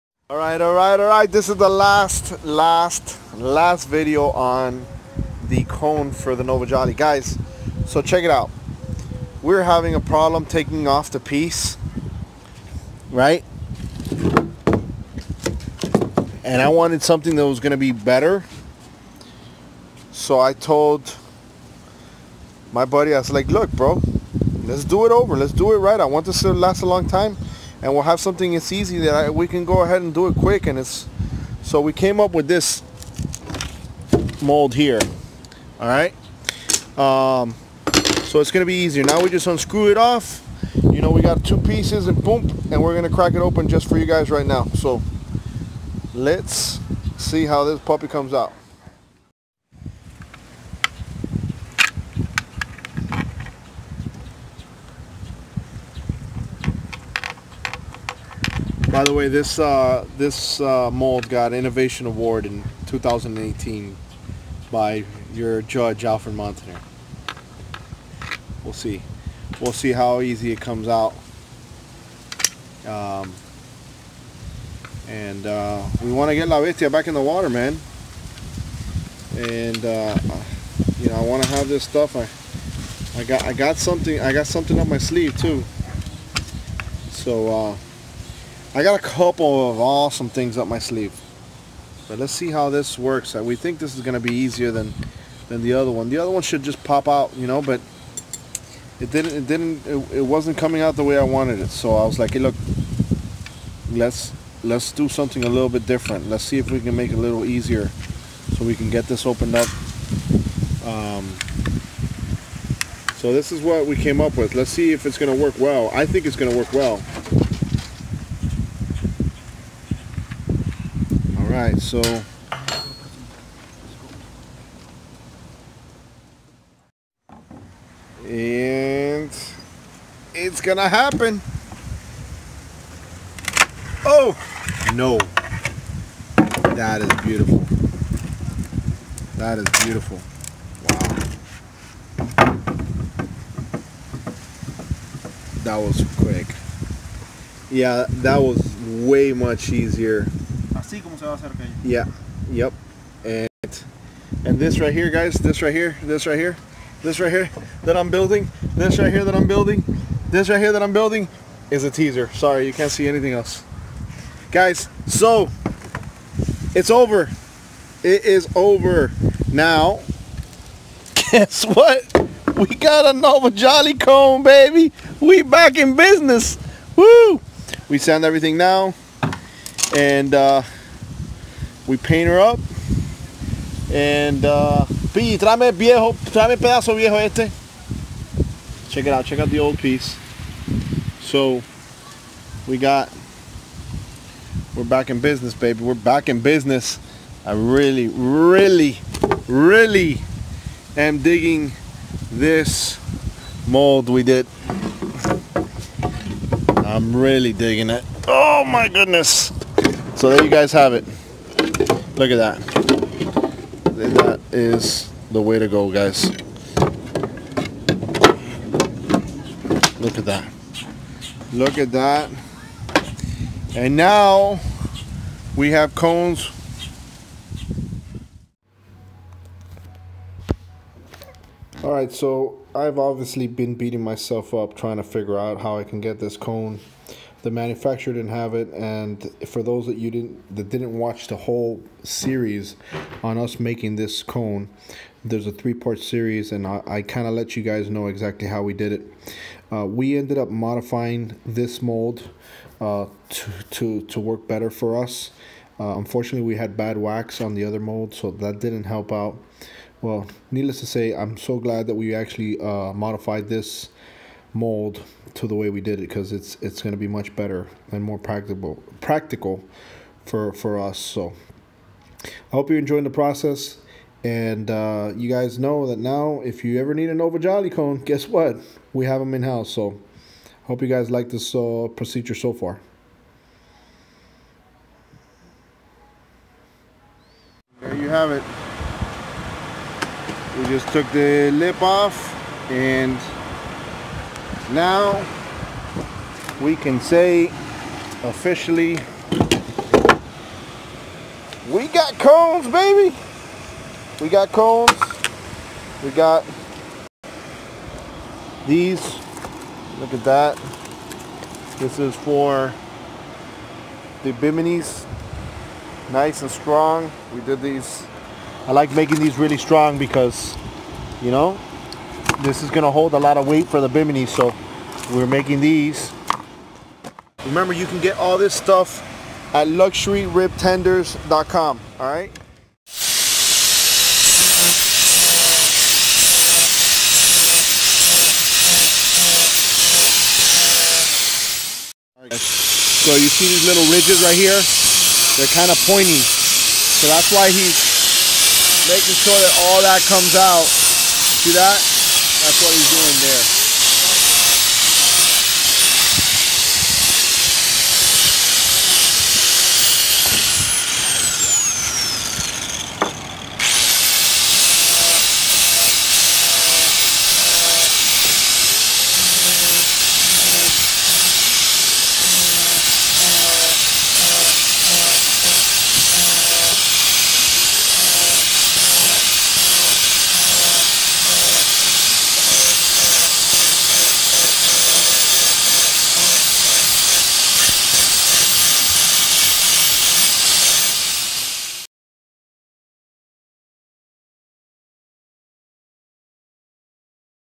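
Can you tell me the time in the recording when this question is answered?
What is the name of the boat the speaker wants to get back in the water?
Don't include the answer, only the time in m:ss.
1:16.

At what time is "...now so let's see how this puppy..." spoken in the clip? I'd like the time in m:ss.
0:44.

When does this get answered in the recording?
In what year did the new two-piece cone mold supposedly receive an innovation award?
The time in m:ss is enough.
1:02.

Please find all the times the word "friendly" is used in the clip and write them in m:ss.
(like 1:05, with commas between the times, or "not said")
not said.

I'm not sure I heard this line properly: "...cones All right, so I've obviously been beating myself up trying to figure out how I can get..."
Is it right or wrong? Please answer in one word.
right.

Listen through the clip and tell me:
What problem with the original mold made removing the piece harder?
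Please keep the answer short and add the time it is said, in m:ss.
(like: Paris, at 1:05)
Bad wax, at 4:16.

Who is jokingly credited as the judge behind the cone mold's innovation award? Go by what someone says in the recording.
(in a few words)
Alfred Montaner.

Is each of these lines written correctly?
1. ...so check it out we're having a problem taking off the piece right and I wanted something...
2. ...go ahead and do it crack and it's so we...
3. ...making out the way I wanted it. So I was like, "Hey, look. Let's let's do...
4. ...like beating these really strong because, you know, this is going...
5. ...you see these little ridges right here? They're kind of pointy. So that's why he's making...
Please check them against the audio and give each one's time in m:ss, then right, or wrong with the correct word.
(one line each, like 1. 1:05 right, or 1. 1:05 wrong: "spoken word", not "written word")
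1. 0:07 right
2. 0:29 wrong: "quick", not "crack"
3. 1:40 wrong: "coming", not "making"
4. 5:18 wrong: "making", not "beating"
5. 5:43 right.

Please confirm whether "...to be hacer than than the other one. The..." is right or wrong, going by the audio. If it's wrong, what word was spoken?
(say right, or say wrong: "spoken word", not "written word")
wrong: "easier", not "hacer".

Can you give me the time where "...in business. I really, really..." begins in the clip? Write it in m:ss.
3:16.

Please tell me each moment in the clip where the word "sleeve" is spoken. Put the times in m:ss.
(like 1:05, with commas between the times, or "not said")
1:24, 1:30.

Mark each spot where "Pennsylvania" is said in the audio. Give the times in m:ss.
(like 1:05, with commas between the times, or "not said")
not said.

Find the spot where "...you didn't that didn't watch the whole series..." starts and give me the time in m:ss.
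3:59.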